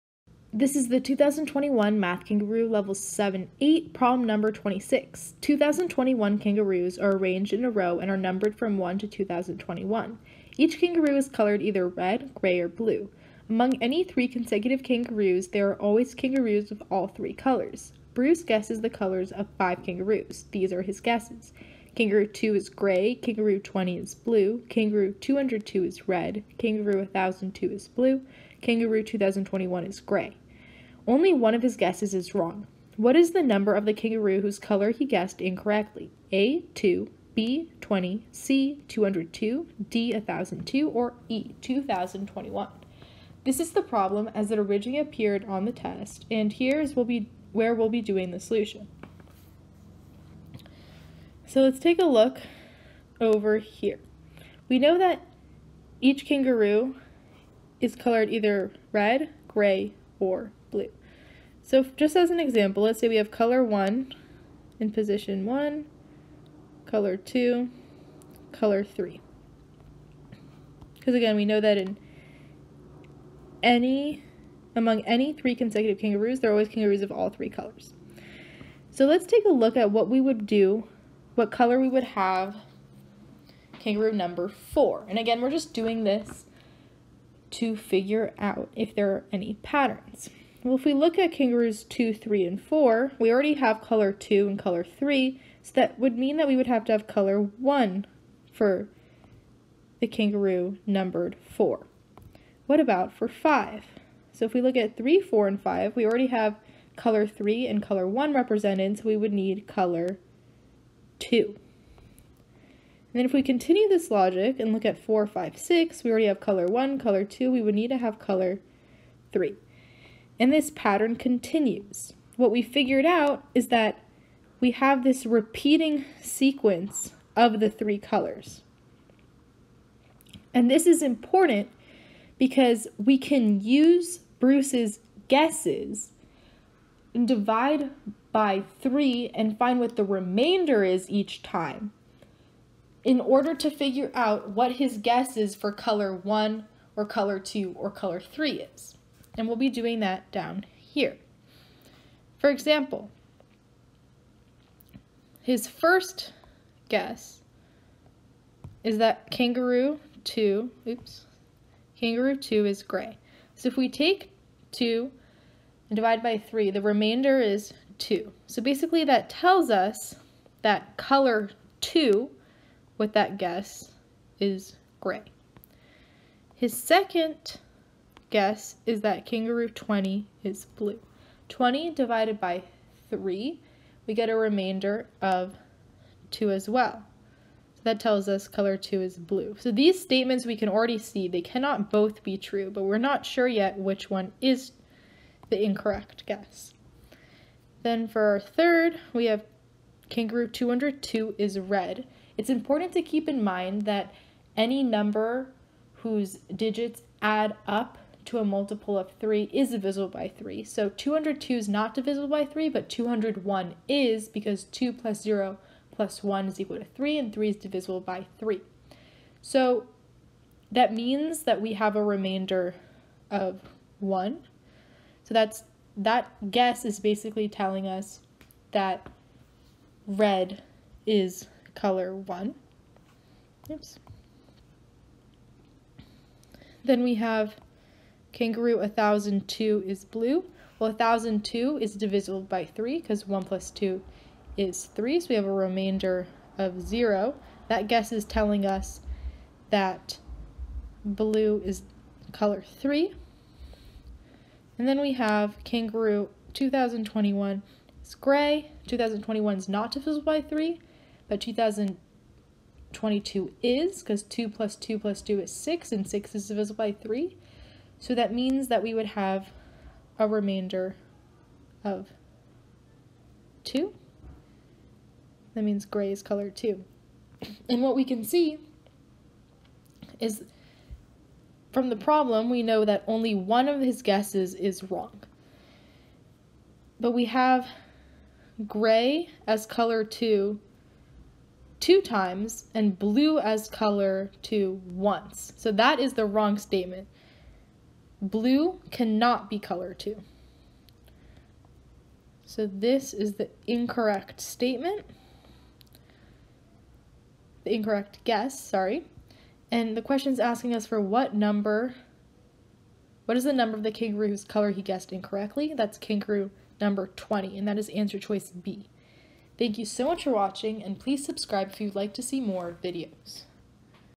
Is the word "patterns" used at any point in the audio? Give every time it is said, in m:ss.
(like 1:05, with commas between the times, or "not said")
1:29, 2:00.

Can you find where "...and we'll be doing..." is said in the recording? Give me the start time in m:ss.
2:29.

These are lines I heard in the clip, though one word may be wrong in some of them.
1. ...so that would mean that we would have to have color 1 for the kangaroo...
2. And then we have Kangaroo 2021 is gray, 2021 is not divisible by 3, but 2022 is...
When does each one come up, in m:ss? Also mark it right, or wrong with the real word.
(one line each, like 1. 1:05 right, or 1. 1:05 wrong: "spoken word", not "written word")
1. 1:35 right
2. 4:14 right.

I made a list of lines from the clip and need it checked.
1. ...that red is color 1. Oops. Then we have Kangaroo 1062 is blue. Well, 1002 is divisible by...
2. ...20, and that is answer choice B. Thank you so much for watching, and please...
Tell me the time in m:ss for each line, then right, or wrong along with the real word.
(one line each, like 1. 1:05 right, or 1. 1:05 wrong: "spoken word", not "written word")
1. 3:48 wrong: "1002", not "1062"
2. 5:17 right.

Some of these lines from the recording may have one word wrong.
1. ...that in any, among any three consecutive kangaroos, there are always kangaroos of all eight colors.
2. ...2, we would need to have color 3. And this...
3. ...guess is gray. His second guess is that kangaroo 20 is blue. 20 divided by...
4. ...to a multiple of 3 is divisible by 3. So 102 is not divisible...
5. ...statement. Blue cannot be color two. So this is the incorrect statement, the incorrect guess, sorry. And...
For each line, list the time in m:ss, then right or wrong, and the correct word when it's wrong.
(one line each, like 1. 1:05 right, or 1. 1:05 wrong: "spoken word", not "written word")
1. 1:11 wrong: "three", not "eight"
2. 1:57 right
3. 2:53 right
4. 3:28 wrong: "202", not "102"
5. 4:56 right.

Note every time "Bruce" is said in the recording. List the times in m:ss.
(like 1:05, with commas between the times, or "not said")
0:18, 2:14.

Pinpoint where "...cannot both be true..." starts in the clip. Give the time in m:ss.
3:11.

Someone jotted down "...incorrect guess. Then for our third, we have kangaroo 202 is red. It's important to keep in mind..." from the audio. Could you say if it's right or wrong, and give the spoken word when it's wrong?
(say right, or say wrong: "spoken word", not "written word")
right.